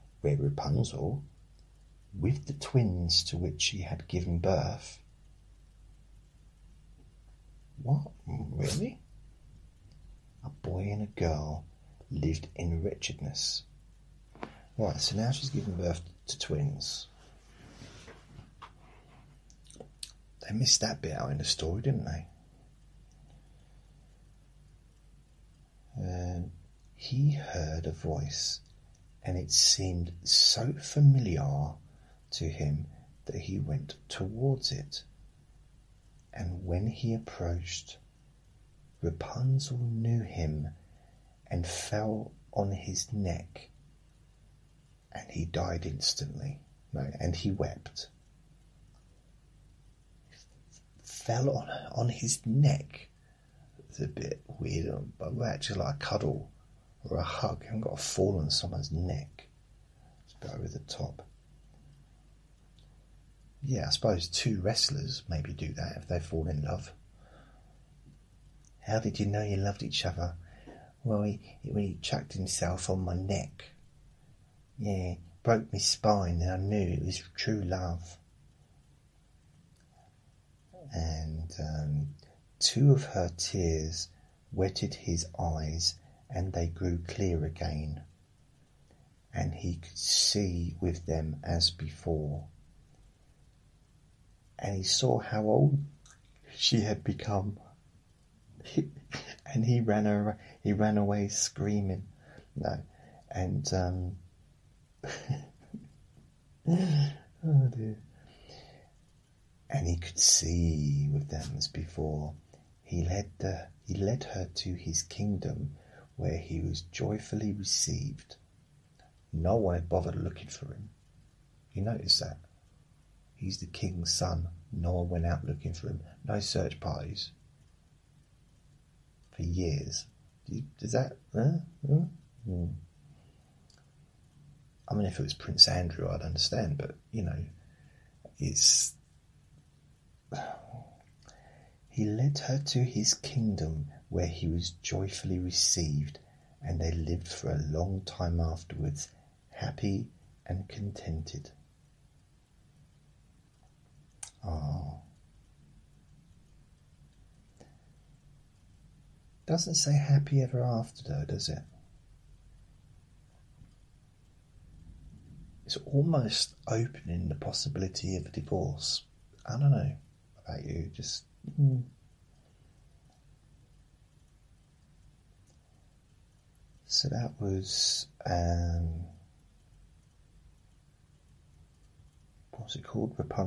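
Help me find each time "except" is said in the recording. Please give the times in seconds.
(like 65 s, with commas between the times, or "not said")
not said.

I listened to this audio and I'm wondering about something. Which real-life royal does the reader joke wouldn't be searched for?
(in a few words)
Prince Andrew.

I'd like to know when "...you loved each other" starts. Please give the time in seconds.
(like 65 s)
69 s.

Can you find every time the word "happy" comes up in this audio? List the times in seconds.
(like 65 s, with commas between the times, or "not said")
149 s, 159 s.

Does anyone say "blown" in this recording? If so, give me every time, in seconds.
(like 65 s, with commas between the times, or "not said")
not said.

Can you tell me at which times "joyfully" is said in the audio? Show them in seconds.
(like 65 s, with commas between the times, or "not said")
116 s, 144 s.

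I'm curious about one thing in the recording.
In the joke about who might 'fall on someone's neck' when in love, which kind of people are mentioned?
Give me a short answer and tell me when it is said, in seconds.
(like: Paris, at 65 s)
wrestlers, at 64 s.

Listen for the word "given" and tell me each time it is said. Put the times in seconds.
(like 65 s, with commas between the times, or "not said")
4 s, 15 s.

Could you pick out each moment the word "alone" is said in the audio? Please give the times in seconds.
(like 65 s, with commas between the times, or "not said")
not said.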